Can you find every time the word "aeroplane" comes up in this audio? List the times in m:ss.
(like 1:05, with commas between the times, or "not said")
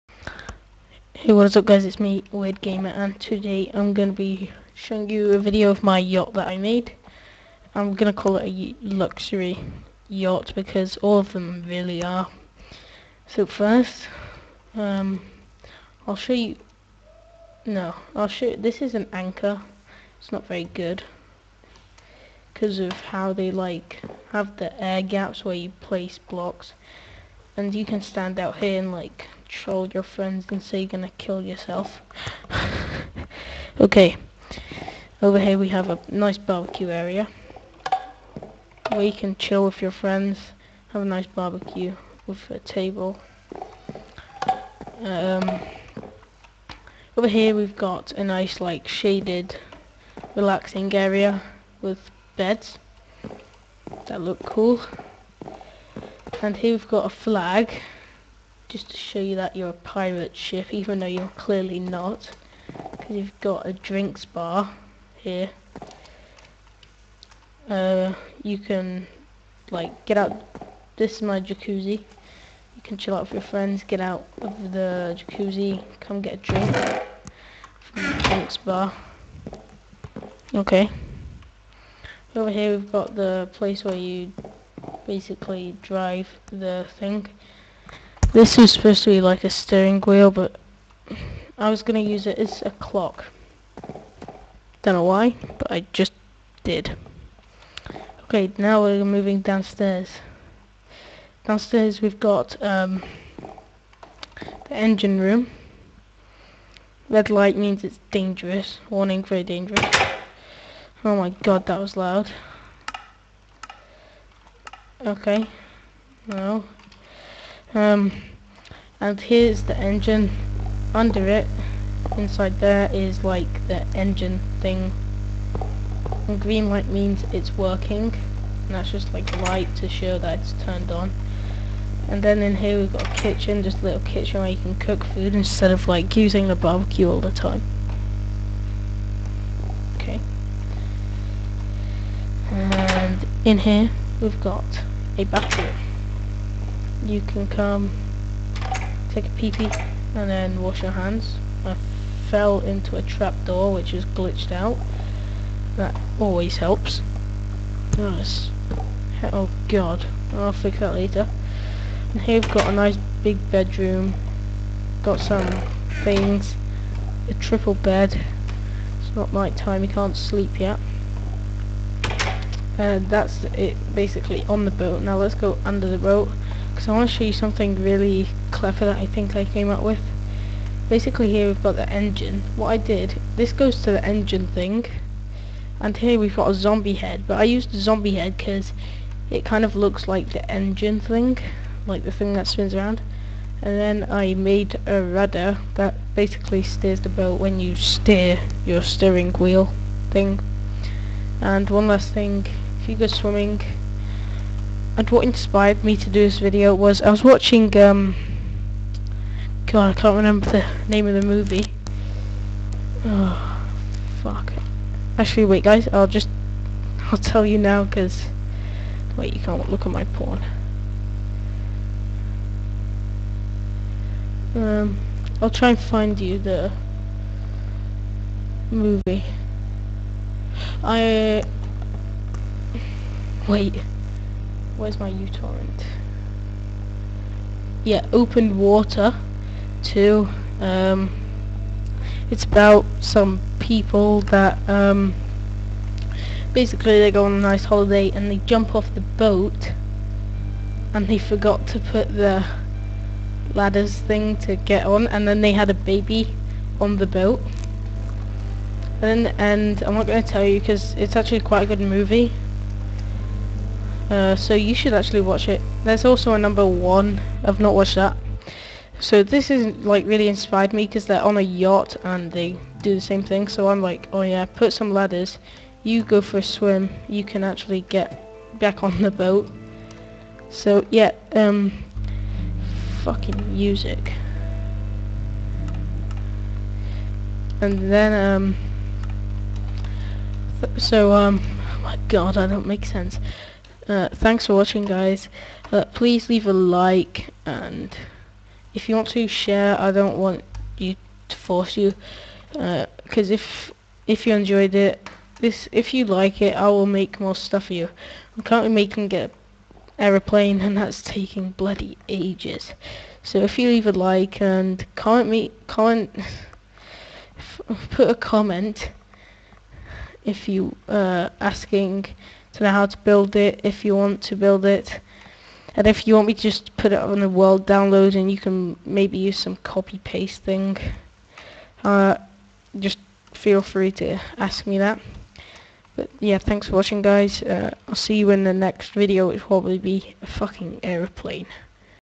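5:09, 5:40.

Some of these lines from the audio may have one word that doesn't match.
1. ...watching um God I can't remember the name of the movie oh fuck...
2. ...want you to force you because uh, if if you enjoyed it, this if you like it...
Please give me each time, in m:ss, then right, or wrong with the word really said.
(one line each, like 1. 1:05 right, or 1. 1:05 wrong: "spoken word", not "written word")
1. 3:27 right
2. 5:00 right.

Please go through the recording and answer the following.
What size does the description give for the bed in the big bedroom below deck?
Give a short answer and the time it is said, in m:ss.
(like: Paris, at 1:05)
triple, at 2:47.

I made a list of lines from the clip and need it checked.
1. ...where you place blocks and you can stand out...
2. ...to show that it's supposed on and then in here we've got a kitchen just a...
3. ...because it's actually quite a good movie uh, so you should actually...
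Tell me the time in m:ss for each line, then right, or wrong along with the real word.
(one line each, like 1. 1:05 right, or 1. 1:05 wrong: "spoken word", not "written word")
1. 0:25 right
2. 2:09 wrong: "turned", not "supposed"
3. 4:20 right.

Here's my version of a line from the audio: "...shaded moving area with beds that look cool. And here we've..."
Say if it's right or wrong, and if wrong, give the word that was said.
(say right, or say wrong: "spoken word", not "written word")
wrong: "relaxing", not "moving".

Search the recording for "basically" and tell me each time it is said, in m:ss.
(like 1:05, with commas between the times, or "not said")
1:25, 2:53, 3:00, 3:16, 4:06.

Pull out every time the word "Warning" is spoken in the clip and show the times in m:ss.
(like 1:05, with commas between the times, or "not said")
1:48.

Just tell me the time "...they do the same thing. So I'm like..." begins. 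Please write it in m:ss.
4:32.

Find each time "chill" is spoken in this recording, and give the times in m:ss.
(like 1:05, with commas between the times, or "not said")
0:39, 1:12.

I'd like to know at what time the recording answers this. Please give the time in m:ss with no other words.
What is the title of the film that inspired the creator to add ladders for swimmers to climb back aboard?
3:58.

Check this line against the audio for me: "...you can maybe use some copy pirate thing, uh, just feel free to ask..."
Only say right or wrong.
wrong.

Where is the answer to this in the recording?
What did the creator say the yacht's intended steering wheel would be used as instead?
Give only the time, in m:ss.
1:32.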